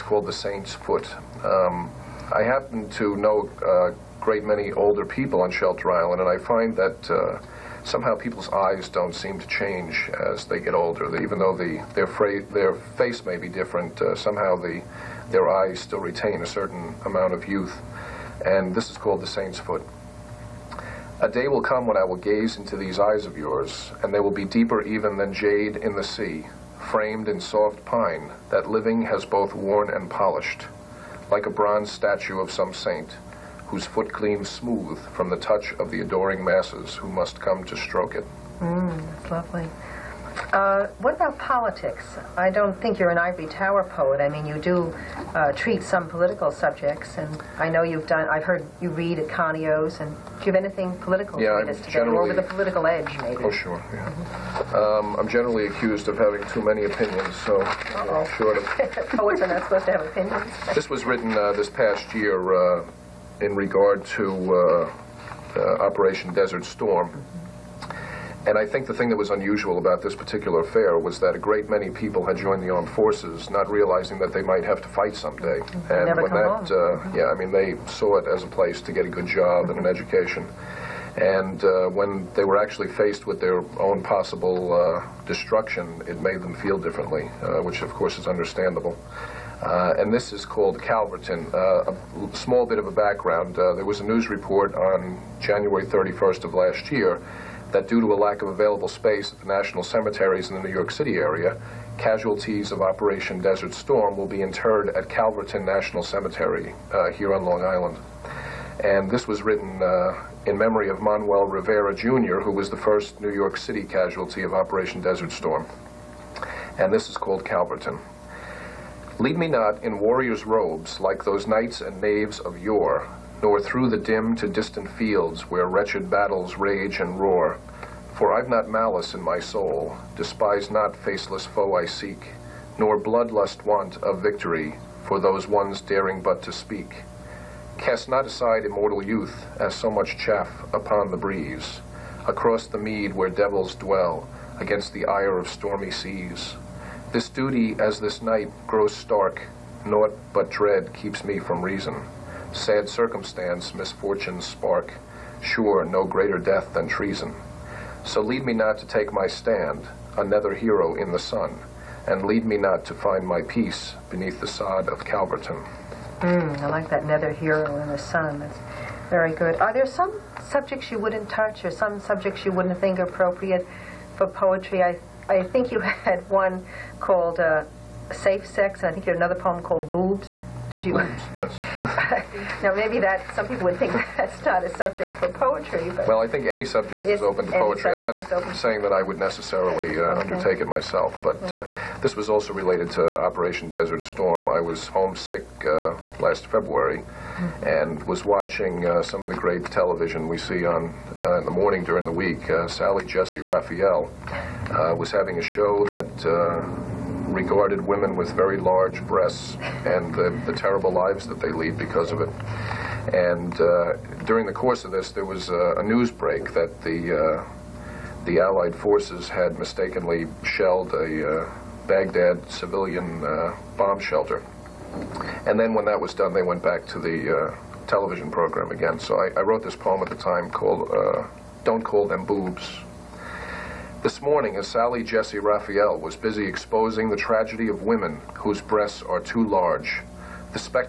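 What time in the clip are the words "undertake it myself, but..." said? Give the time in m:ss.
3:10.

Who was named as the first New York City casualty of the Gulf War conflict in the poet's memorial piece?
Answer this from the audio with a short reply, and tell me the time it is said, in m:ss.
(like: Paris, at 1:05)
Manuel Rivera Jr., at 1:51.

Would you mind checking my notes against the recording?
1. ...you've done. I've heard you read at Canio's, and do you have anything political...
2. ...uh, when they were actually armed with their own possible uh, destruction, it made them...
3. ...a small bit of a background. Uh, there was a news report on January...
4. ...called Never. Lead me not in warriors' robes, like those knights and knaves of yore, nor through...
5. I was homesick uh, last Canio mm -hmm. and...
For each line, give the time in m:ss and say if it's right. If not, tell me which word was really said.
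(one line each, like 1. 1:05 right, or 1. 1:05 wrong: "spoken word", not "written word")
1. 0:47 right
2. 1:21 wrong: "faced", not "armed"
3. 1:31 right
4. 1:57 wrong: "Calverton", not "Never"
5. 3:14 wrong: "February", not "Canio".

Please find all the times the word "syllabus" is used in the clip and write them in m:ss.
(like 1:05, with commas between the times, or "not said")
not said.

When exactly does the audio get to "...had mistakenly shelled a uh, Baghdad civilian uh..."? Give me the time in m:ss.
3:39.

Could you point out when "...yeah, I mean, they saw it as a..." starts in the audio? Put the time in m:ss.
1:17.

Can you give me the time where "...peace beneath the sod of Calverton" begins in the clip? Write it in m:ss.
2:43.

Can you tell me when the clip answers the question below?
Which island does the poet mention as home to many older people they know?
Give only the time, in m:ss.
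0:05.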